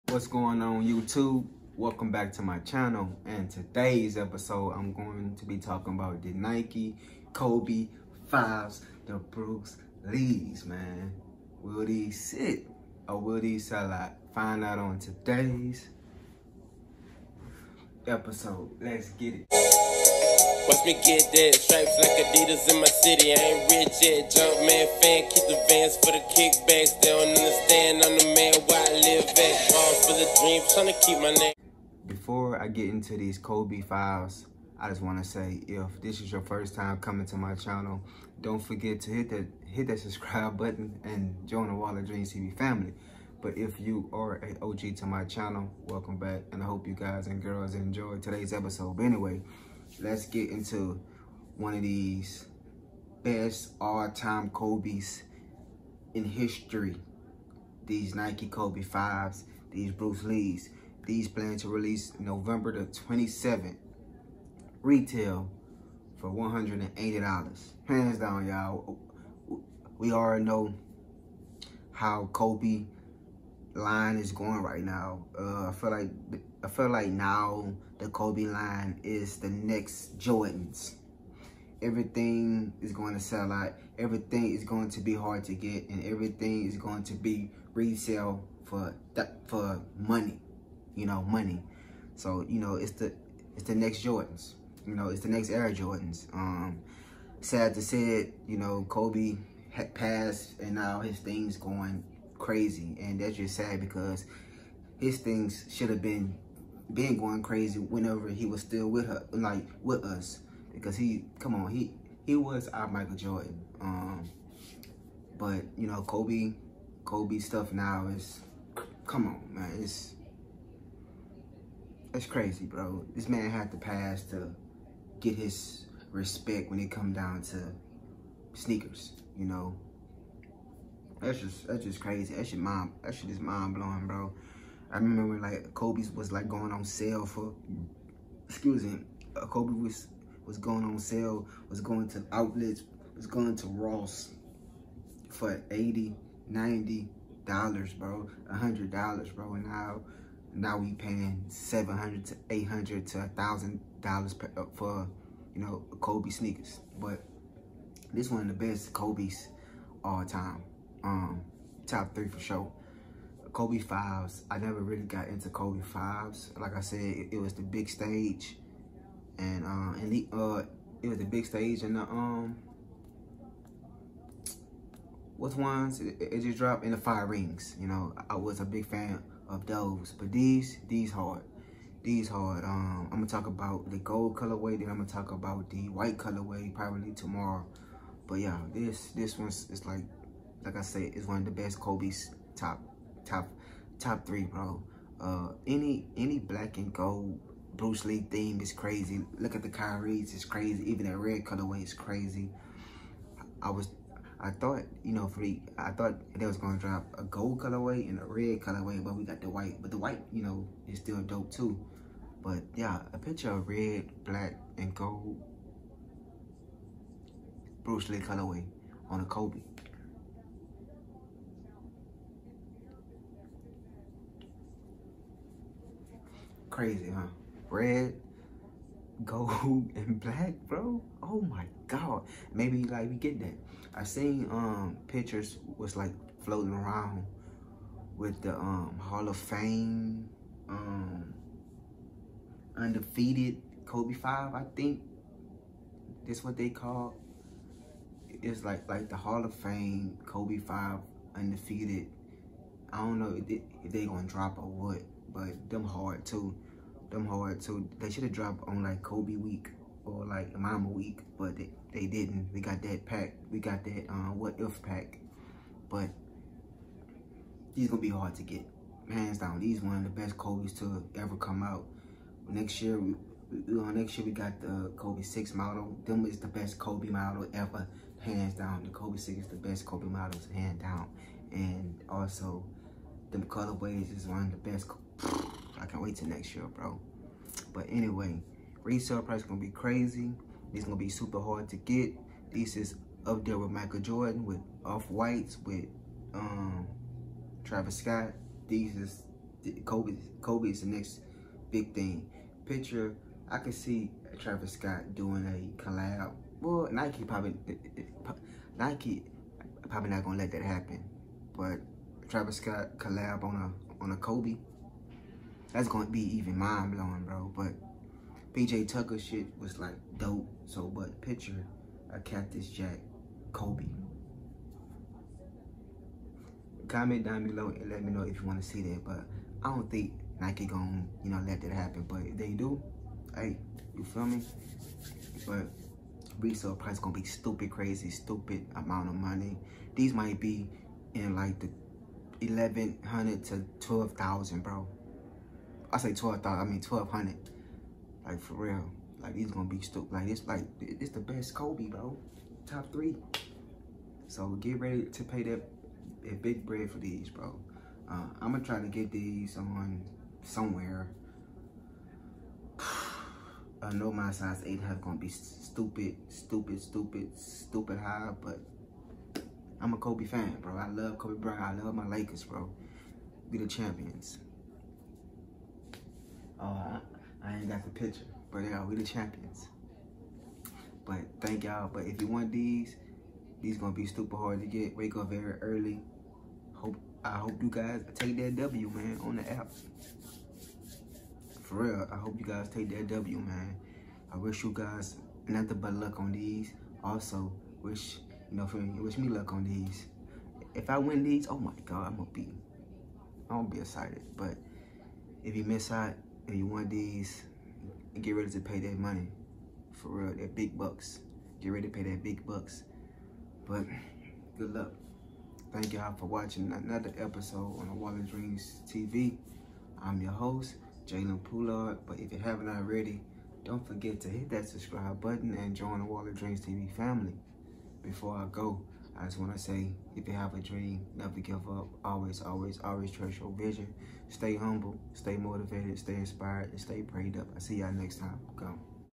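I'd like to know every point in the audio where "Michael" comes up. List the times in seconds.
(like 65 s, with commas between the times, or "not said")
112 s, 293 s.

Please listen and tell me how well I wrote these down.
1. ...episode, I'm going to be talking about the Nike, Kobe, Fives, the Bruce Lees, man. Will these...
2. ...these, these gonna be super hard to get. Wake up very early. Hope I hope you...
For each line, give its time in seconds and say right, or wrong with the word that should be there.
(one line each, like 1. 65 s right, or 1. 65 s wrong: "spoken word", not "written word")
1. 4 s right
2. 382 s right.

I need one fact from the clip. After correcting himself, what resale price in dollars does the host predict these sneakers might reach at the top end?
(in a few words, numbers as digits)
1,200.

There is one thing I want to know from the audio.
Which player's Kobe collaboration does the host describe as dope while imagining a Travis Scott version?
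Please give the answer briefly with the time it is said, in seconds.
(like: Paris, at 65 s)
PJ Tucker, at 318 s.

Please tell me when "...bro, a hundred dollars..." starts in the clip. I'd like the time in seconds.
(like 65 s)
147 s.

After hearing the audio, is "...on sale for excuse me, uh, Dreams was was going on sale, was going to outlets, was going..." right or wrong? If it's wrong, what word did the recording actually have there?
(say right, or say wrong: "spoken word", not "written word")
wrong: "Kobe", not "Dreams".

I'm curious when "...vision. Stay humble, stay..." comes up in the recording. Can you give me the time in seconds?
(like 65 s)
433 s.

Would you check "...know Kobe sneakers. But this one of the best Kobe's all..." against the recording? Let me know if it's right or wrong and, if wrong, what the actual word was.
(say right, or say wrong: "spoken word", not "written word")
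right.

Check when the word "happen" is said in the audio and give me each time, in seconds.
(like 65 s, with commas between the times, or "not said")
310 s, 331 s.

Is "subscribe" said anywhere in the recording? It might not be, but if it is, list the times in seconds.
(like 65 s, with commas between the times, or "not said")
39 s, 424 s.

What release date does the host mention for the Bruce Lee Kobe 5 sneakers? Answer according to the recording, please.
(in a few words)
November 27.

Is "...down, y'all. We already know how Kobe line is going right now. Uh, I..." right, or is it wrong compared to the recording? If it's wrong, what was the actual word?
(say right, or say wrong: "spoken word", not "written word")
right.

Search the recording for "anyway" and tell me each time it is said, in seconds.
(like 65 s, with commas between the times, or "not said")
49 s, 287 s.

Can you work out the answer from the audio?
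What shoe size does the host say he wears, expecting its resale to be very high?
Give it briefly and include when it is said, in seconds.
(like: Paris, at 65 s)
8, at 364 s.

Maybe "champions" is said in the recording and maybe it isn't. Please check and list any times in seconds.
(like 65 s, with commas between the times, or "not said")
373 s, 379 s.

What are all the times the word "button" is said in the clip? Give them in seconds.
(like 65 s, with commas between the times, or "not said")
40 s, 425 s.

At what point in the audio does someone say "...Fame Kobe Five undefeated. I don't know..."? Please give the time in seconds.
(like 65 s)
249 s.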